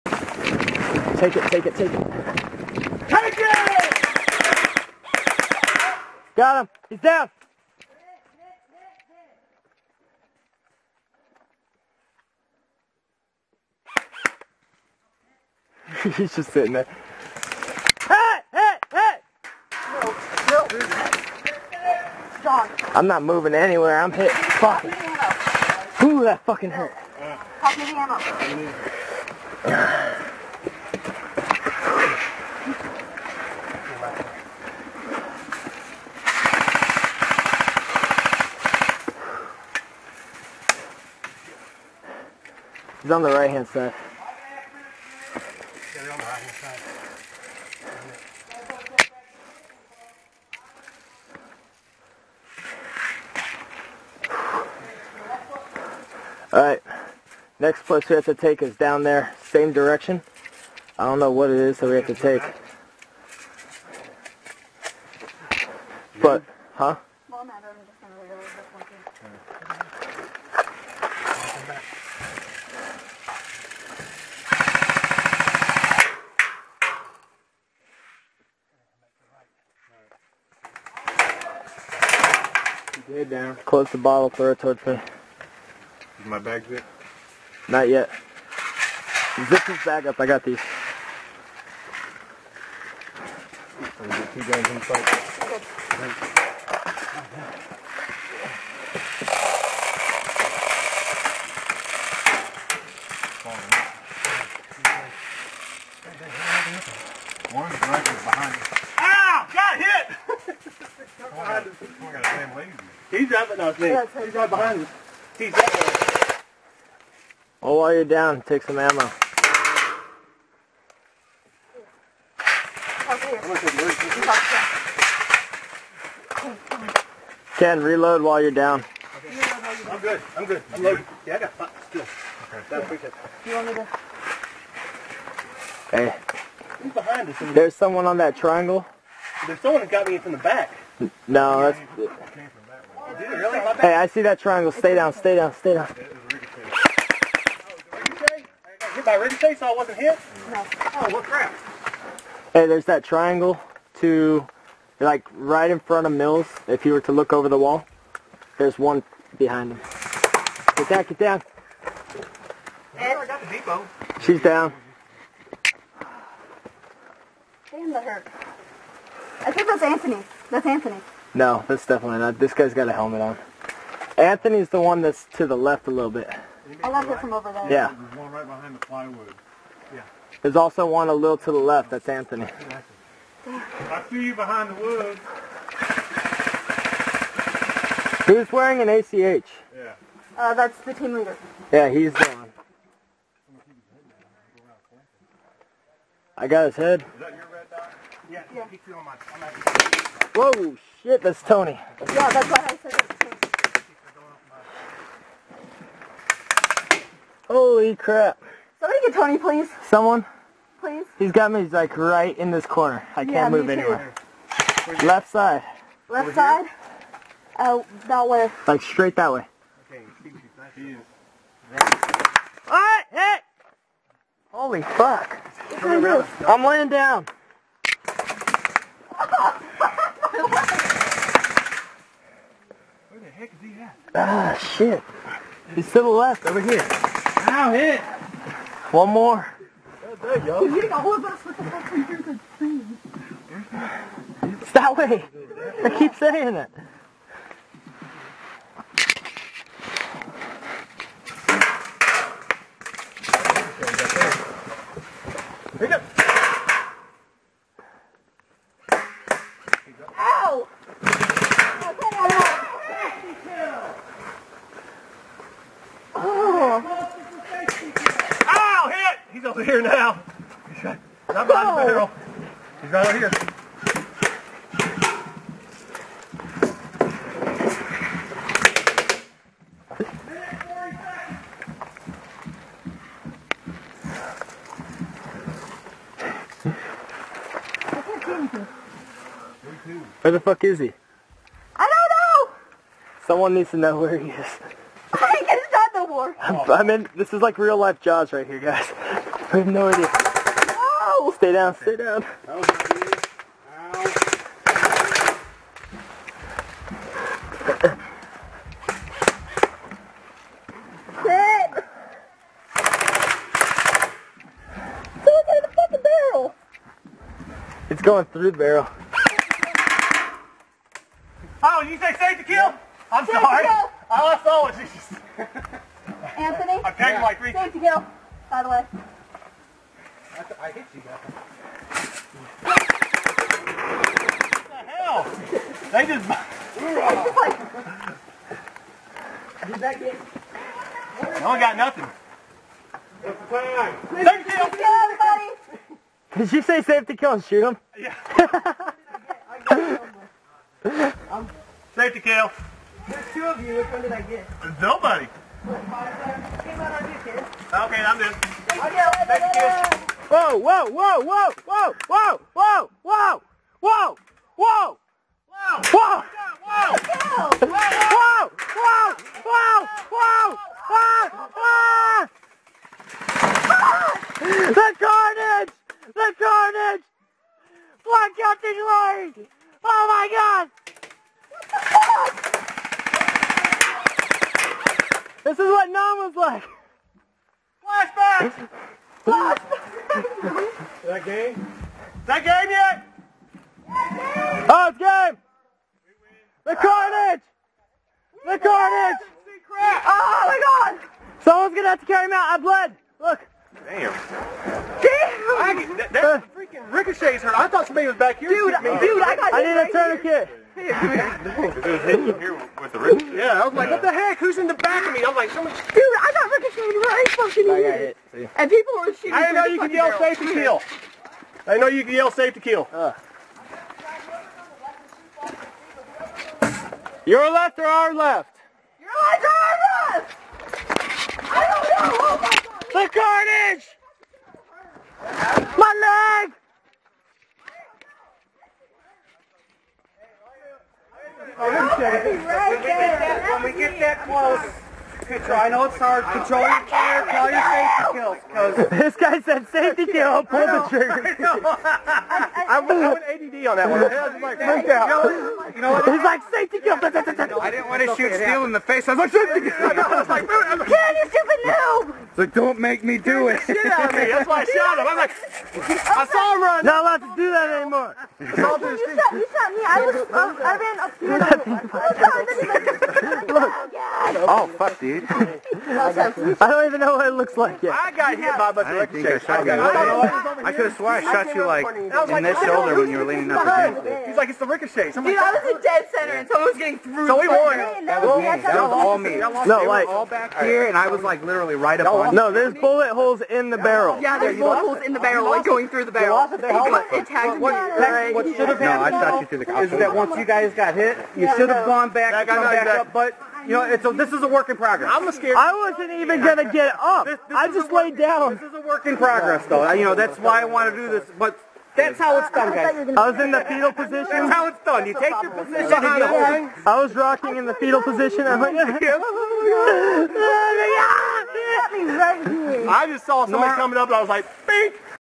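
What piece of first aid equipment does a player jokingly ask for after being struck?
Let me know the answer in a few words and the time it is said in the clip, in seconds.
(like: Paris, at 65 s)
A tourniquet, at 409 s.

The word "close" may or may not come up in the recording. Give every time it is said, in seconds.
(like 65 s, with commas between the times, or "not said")
83 s, 444 s.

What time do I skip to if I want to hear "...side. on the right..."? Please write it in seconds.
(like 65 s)
43 s.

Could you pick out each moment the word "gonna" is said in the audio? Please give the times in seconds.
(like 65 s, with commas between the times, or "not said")
401 s, 506 s.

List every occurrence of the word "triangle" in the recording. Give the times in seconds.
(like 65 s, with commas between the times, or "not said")
138 s, 144 s, 153 s.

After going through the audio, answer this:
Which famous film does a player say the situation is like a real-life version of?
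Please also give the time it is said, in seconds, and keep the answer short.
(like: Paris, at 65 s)
Jaws, at 297 s.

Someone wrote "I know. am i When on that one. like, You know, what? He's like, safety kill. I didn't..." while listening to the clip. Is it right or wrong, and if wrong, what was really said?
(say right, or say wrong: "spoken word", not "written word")
wrong: "ADD", not "When".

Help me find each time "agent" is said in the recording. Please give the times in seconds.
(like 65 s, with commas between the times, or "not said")
not said.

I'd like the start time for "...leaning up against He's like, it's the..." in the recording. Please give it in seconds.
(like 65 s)
483 s.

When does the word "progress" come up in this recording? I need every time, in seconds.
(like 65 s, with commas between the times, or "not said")
504 s, 509 s.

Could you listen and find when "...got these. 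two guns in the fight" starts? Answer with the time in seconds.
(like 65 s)
90 s.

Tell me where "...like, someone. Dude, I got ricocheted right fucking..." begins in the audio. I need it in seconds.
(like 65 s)
415 s.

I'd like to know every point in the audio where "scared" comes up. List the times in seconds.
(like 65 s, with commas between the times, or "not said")
505 s.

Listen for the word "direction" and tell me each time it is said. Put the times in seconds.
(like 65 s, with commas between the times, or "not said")
59 s.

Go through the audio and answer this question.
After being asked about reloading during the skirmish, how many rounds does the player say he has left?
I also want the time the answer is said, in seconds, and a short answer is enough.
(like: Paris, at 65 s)
5, at 131 s.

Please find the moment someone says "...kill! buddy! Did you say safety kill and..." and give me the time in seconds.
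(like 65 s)
344 s.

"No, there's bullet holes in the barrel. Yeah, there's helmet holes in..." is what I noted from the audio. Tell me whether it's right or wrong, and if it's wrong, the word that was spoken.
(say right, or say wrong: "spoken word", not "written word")
wrong: "bullet", not "helmet".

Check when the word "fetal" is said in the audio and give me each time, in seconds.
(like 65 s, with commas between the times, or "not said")
513 s, 517 s.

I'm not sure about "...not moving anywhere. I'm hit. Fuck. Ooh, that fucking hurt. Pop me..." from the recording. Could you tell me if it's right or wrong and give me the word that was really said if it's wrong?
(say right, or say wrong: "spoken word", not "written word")
right.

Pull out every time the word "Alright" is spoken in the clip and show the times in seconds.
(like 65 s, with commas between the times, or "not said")
56 s, 222 s.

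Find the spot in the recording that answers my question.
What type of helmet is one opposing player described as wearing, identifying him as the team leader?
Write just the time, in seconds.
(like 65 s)
188 s.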